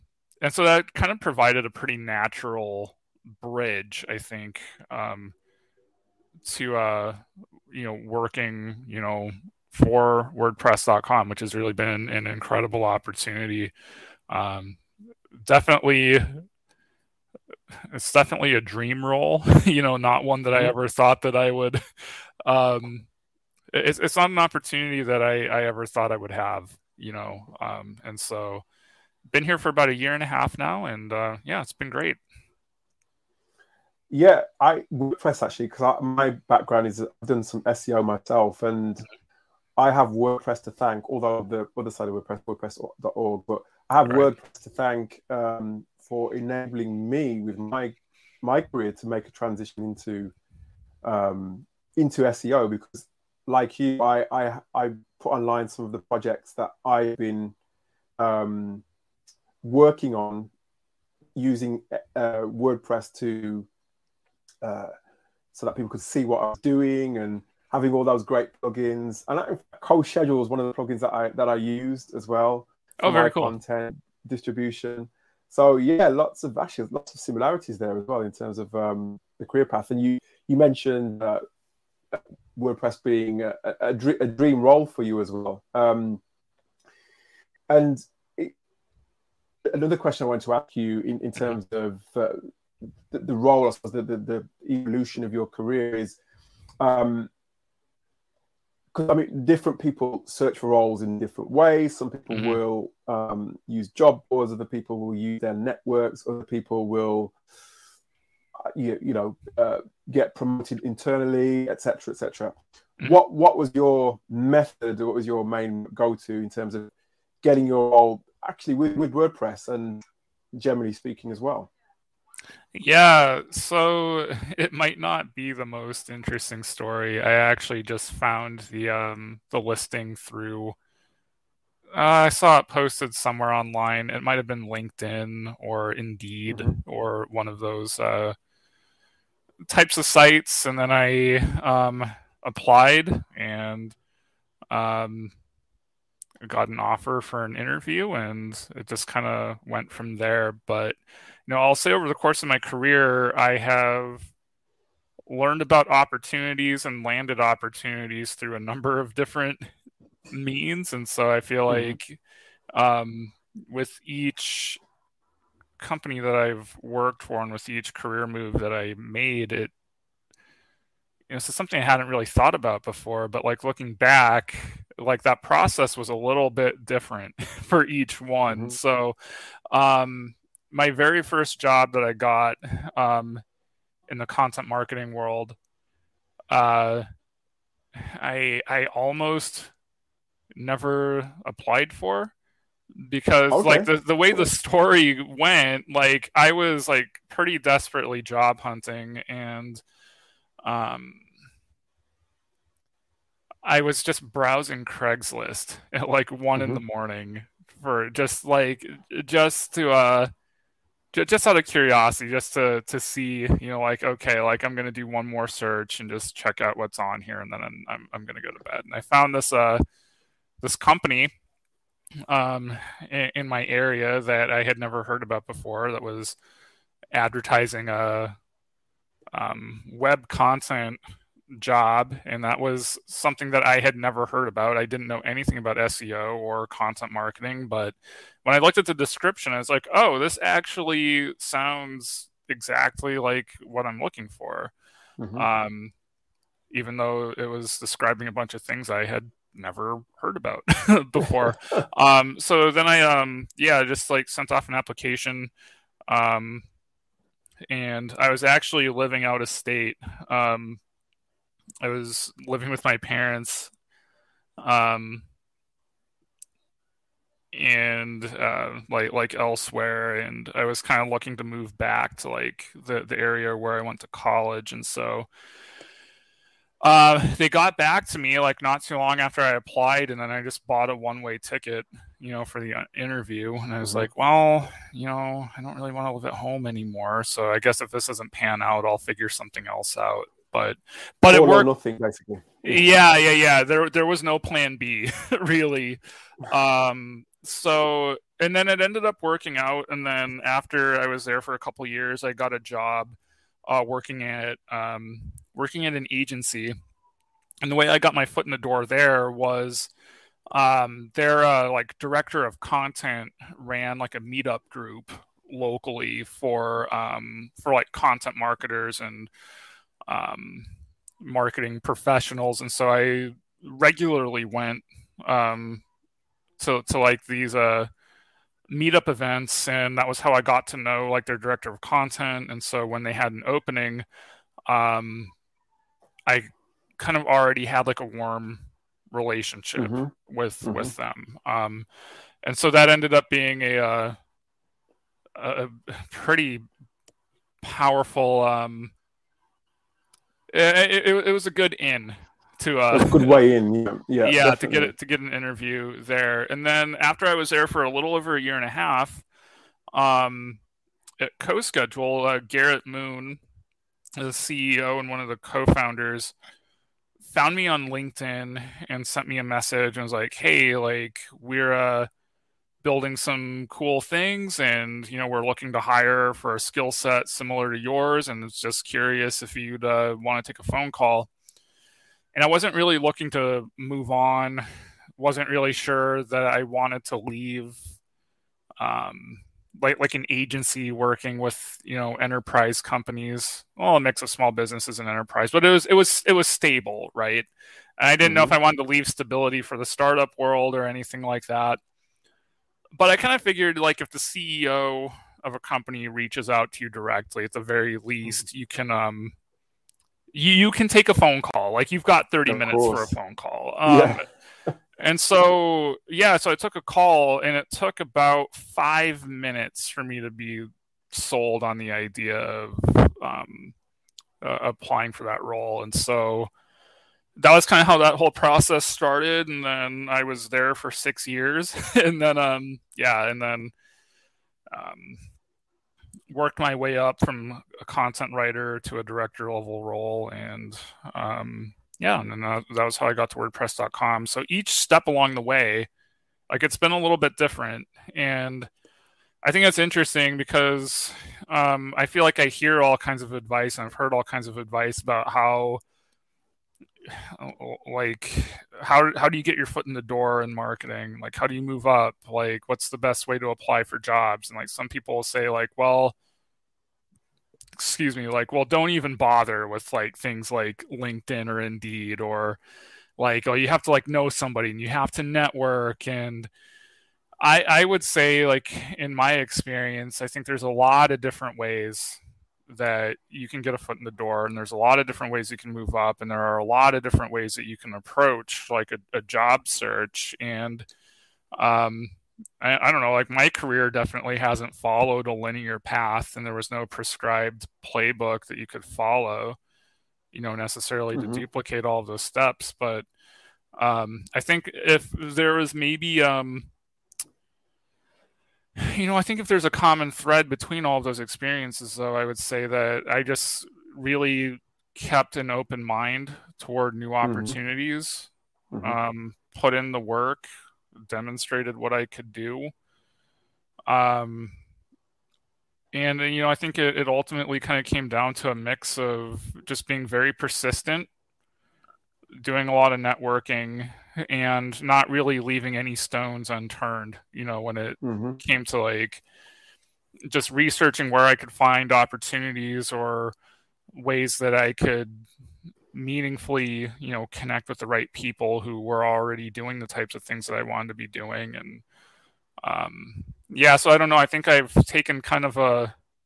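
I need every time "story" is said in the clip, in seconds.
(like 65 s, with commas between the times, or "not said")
126 s, 194 s.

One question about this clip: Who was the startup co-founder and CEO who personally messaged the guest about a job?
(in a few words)
Garrett Moon.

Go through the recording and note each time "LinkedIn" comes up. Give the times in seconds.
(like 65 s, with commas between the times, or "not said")
134 s, 367 s, 470 s.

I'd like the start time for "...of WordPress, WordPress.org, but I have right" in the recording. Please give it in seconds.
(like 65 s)
42 s.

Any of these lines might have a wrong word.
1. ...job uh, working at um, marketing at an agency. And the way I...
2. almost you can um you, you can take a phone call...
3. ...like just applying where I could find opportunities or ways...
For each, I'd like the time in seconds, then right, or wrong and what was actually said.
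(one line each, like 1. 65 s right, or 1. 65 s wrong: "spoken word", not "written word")
1. 302 s wrong: "working", not "marketing"
2. 408 s wrong: "least", not "almost"
3. 538 s wrong: "researching", not "applying".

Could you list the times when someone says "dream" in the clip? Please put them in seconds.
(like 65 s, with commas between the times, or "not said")
18 s, 84 s.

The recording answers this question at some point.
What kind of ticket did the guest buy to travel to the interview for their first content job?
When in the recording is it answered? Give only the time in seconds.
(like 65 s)
280 s.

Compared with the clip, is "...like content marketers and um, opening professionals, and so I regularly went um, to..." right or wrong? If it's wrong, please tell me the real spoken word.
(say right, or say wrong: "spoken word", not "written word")
wrong: "marketing", not "opening".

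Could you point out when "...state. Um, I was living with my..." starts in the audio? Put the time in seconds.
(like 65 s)
259 s.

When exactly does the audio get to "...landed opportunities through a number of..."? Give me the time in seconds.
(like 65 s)
157 s.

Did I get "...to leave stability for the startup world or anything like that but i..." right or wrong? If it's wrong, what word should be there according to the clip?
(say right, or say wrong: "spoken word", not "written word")
right.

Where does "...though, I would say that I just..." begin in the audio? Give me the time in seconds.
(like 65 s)
511 s.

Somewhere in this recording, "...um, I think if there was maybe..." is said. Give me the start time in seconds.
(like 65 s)
503 s.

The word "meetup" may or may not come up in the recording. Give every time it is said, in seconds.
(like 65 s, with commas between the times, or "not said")
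314 s, 328 s.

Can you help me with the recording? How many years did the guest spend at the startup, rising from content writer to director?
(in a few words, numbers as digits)
6 years.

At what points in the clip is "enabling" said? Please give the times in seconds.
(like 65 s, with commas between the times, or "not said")
46 s.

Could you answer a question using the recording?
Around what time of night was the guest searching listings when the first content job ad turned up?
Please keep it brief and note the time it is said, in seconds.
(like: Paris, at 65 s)
1 in the morning, at 206 s.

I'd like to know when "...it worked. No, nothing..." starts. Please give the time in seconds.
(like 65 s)
291 s.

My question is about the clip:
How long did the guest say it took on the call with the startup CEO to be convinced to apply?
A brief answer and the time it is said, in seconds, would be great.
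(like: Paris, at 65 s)
about 5 minutes, at 417 s.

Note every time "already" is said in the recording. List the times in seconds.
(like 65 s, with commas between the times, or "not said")
337 s, 549 s.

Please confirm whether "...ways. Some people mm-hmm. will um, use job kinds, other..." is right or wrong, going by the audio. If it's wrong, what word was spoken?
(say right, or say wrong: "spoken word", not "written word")
wrong: "boards", not "kinds".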